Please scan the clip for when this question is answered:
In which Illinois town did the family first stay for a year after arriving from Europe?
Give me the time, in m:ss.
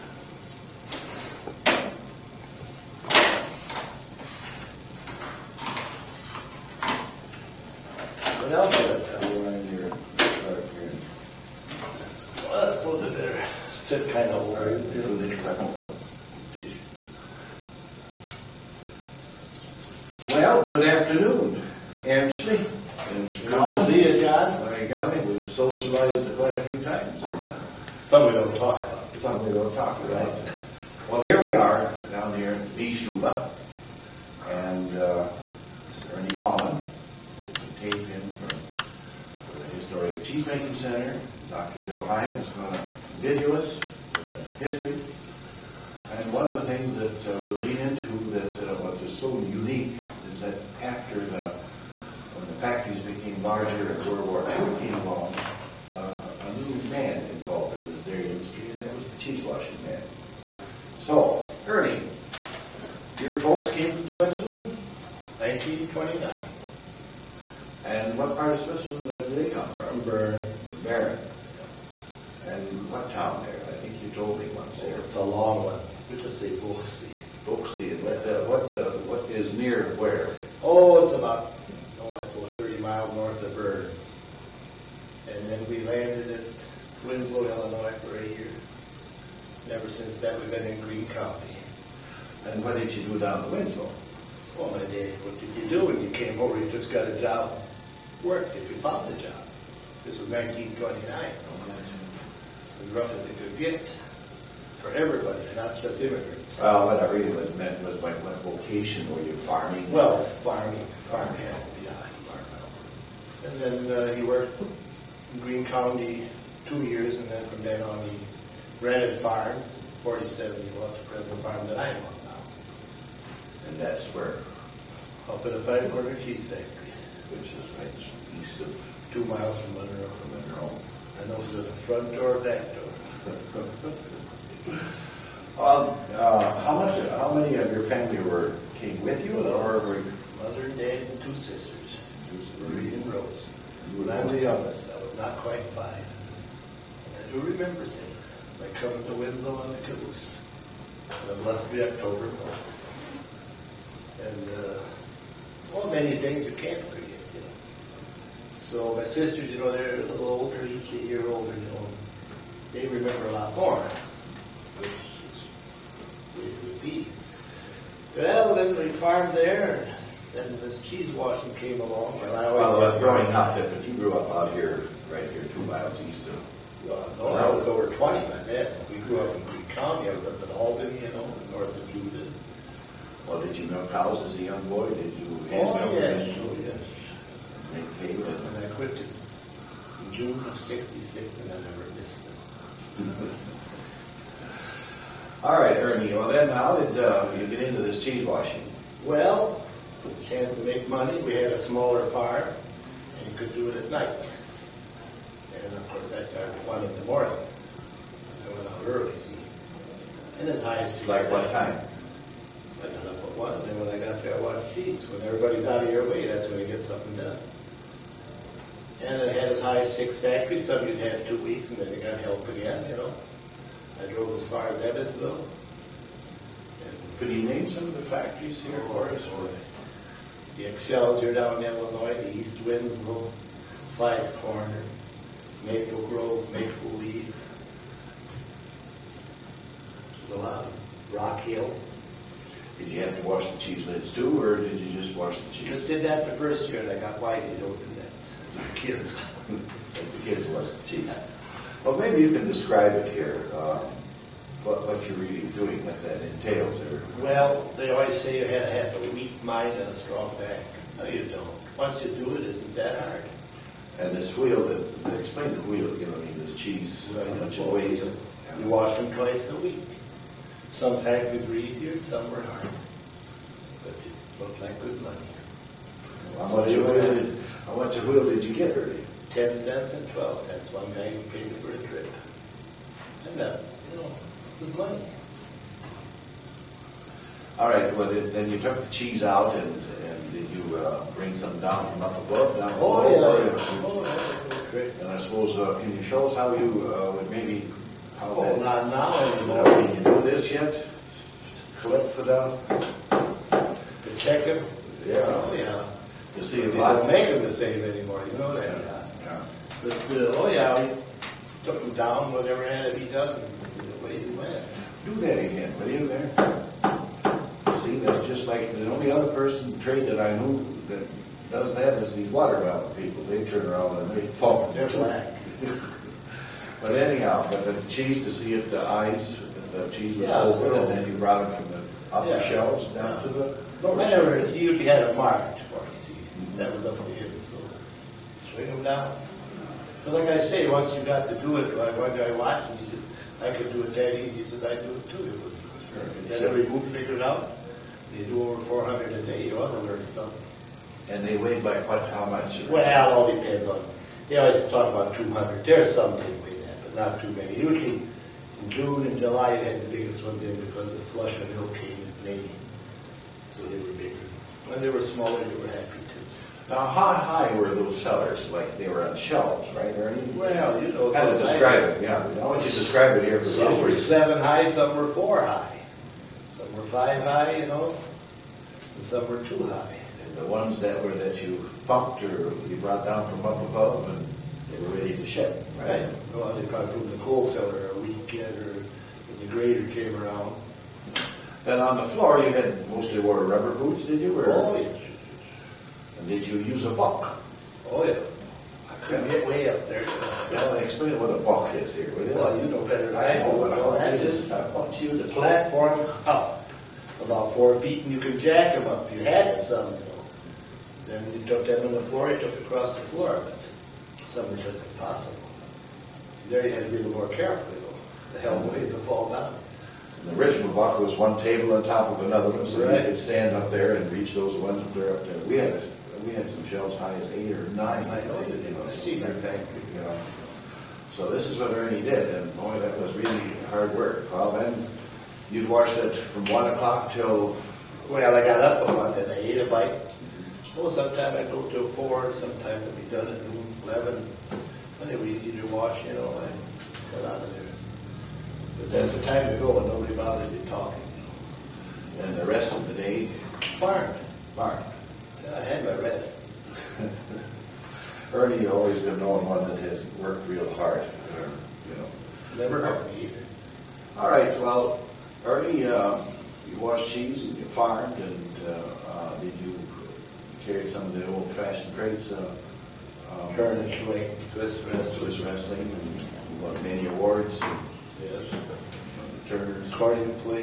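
1:27.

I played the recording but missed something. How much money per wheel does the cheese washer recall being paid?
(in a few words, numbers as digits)
10 and 12 cents.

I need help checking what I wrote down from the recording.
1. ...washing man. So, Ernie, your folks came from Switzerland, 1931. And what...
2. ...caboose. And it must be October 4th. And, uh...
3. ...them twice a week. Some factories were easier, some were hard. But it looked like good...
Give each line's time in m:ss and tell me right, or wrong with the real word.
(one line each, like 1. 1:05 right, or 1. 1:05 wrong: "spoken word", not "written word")
1. 0:59 wrong: "1929", not "1931"
2. 2:29 right
3. 4:28 right.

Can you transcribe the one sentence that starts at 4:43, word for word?
And that, uh, you know to blame.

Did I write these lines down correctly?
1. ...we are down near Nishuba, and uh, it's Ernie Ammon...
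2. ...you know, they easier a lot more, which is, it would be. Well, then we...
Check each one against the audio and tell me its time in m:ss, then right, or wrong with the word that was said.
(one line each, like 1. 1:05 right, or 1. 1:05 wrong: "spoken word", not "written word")
1. 0:31 right
2. 2:41 wrong: "remember", not "easier".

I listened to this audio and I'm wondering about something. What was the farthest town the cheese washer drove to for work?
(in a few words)
Evansville.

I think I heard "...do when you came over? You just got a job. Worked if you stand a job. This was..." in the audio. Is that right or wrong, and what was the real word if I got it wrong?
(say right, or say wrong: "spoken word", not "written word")
wrong: "found", not "stand".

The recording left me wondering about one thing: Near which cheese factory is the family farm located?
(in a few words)
Five Quarter Cheese Factory.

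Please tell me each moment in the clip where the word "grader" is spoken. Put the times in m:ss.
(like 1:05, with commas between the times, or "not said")
6:29.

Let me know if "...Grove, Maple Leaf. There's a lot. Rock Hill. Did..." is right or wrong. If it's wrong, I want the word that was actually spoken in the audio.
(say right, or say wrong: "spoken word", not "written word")
right.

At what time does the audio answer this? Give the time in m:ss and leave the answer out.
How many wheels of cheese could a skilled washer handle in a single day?
5:48.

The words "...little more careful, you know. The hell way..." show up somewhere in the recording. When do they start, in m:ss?
6:57.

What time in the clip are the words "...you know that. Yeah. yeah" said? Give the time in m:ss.
5:08.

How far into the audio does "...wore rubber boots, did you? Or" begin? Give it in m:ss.
6:33.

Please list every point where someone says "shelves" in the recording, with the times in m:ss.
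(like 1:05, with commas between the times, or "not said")
5:32, 6:09, 7:06.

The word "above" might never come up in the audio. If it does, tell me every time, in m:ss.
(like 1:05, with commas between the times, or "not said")
4:52, 6:23.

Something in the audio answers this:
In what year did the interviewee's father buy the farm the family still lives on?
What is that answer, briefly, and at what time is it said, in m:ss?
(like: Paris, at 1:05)
1947, at 1:59.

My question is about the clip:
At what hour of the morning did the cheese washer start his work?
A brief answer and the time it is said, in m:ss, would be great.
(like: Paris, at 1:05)
1, at 3:26.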